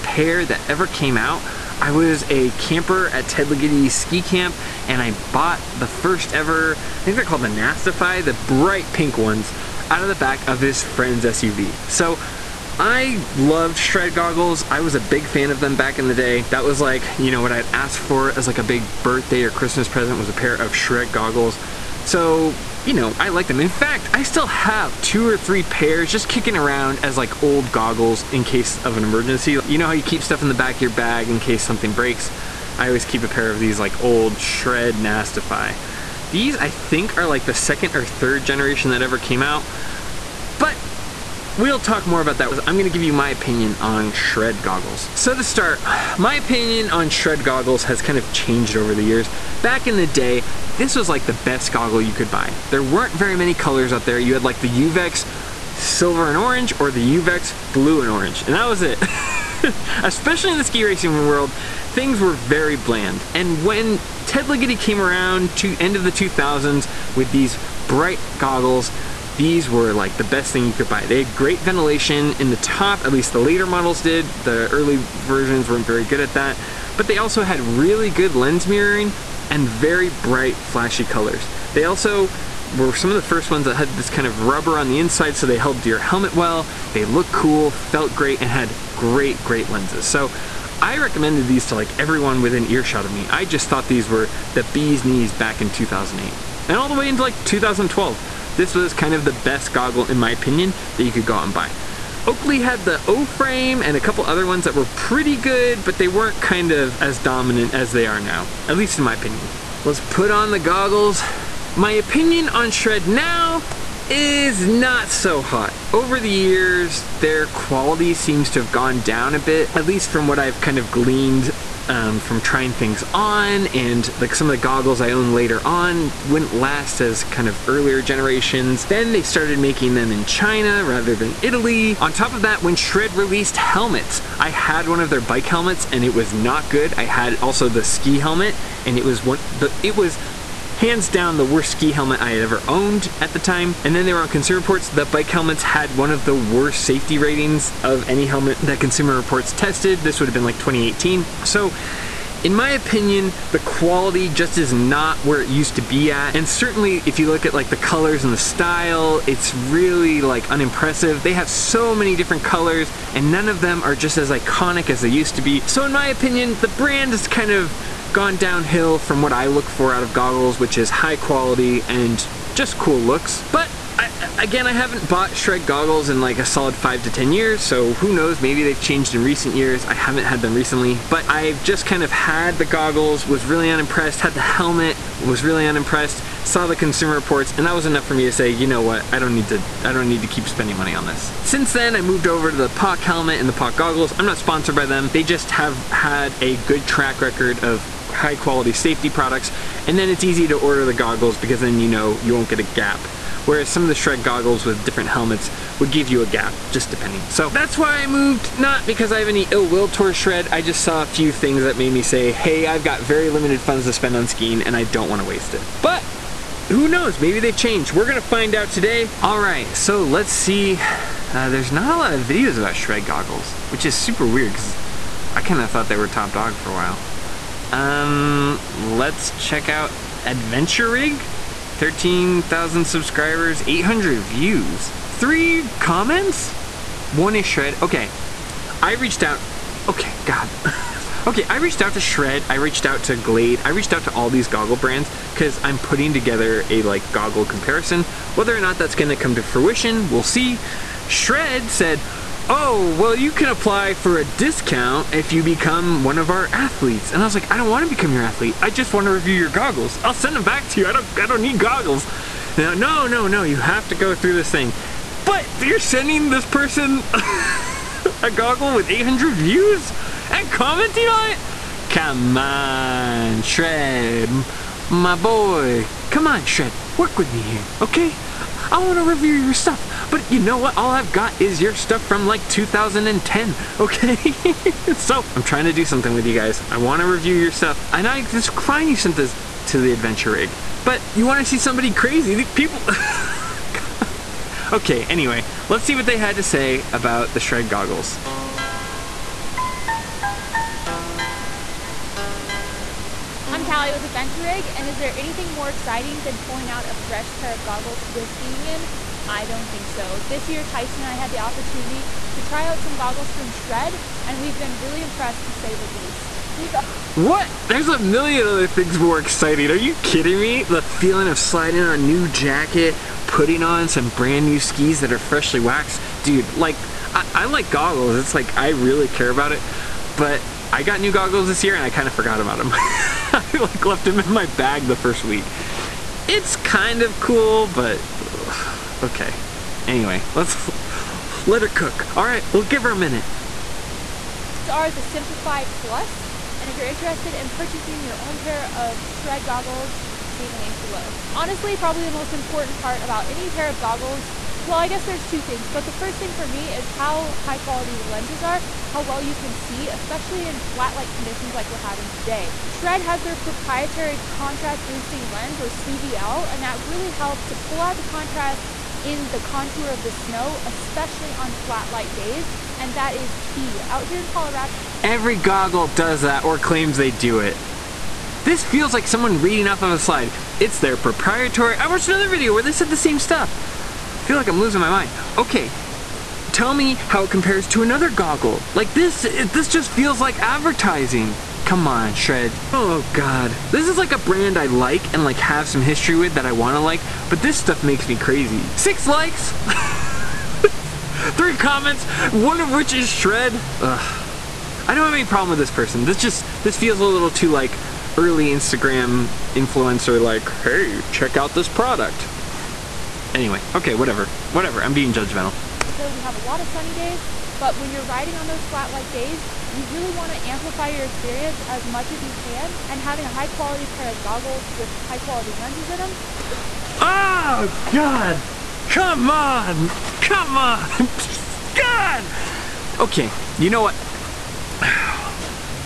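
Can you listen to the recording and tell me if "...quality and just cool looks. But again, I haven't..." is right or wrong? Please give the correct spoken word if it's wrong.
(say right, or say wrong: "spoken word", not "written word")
right.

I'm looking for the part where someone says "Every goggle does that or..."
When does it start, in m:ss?
6:15.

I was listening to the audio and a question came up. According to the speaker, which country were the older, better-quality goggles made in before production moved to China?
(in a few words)
Italy.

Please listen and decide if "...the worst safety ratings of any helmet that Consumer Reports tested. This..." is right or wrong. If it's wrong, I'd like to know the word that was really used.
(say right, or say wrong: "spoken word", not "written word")
right.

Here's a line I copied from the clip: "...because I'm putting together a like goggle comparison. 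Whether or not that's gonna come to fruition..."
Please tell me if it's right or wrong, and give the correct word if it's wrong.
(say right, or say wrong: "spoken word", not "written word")
right.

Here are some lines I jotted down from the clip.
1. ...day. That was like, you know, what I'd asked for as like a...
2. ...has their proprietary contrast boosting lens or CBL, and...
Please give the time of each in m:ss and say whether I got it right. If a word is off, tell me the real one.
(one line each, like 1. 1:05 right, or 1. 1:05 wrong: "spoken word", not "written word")
1. 0:16 right
2. 6:03 right.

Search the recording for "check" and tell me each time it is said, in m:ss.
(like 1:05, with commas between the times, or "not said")
3:49, 6:51.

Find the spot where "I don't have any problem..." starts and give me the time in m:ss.
6:44.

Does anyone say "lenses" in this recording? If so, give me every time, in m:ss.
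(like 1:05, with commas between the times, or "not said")
1:29, 5:58, 7:05.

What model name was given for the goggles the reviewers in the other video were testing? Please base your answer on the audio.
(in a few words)
Simplify Plus.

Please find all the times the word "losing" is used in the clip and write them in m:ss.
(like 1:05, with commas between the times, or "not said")
6:24.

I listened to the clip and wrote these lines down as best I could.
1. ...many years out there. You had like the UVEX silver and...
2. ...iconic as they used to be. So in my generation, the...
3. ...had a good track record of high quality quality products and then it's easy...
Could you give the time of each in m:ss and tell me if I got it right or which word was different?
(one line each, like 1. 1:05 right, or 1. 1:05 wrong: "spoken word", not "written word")
1. 0:53 wrong: "colors", not "years"
2. 2:44 wrong: "opinion", not "generation"
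3. 3:15 wrong: "safety", not "quality".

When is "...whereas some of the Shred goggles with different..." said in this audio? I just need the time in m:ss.
3:23.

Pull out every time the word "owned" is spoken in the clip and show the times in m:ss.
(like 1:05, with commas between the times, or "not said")
2:05, 2:22.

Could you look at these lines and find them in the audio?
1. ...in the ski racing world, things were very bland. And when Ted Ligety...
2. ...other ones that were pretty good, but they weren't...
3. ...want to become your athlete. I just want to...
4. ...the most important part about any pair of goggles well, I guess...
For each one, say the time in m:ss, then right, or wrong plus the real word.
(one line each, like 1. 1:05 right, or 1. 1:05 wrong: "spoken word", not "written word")
1. 1:00 right
2. 1:44 right
3. 4:17 right
4. 5:52 right.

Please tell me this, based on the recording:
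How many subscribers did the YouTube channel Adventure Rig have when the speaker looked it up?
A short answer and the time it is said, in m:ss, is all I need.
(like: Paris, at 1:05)
13,000, at 3:51.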